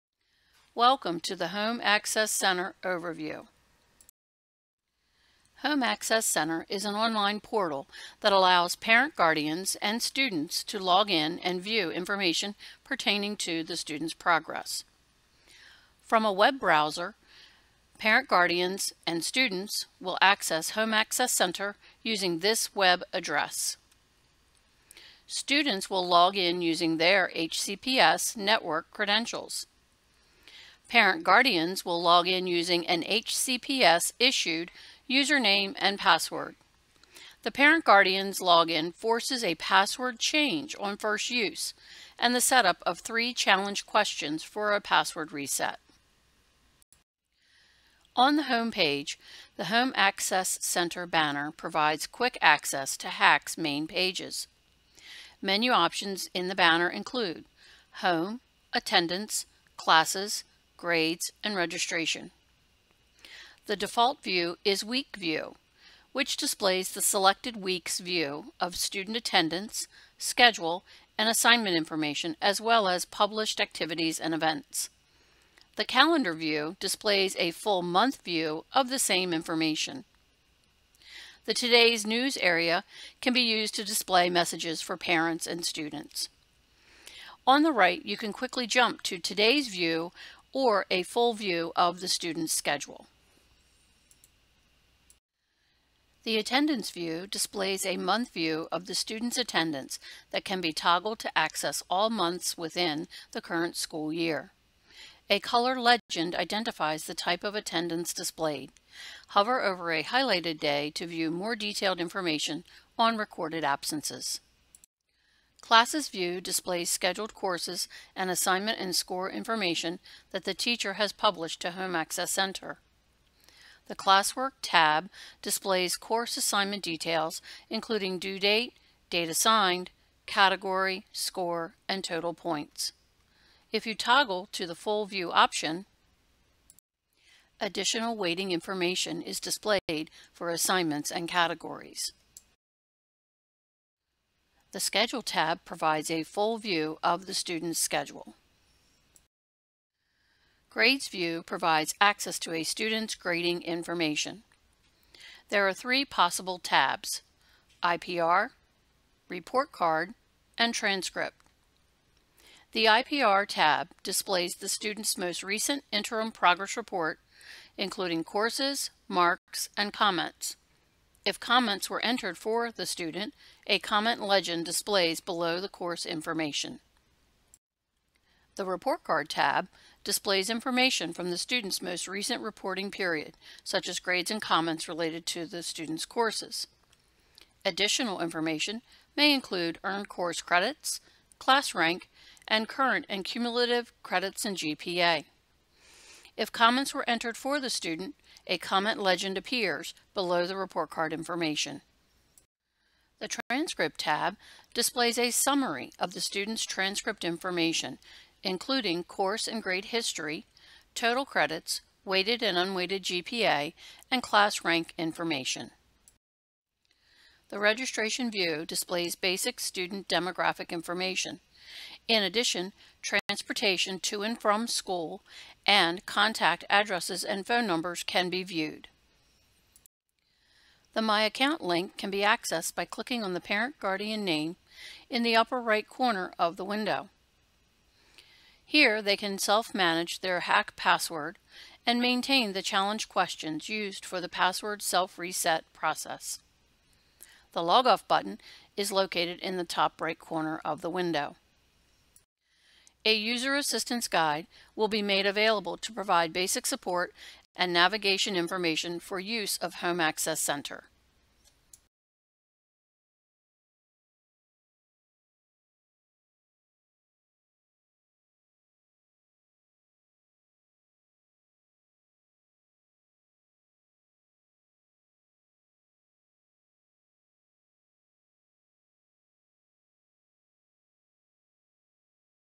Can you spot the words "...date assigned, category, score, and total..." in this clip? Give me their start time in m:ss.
2:09.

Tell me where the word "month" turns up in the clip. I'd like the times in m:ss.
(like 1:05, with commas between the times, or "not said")
1:17, 1:37, 1:42.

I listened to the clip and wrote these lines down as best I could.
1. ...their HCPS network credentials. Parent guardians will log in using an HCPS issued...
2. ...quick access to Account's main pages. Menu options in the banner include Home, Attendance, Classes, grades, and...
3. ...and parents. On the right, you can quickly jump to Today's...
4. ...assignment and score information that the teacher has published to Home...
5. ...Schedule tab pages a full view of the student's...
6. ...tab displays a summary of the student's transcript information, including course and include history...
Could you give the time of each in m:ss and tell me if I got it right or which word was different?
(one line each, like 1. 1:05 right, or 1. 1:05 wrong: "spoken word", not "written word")
1. 0:26 right
2. 0:52 wrong: "HAC", not "Account"
3. 1:25 wrong: "students", not "parents"
4. 1:58 right
5. 2:24 wrong: "provides", not "pages"
6. 3:23 wrong: "grade", not "include".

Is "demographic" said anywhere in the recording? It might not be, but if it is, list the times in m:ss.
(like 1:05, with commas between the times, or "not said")
3:40.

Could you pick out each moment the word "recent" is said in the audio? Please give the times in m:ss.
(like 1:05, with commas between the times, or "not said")
2:45, 3:02.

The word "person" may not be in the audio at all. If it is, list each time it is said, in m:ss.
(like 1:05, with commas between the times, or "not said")
not said.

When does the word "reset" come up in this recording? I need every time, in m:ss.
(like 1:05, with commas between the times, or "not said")
0:45, 4:04.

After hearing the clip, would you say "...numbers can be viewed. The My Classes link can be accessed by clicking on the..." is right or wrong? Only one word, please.
wrong.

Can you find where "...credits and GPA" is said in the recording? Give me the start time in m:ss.
3:14.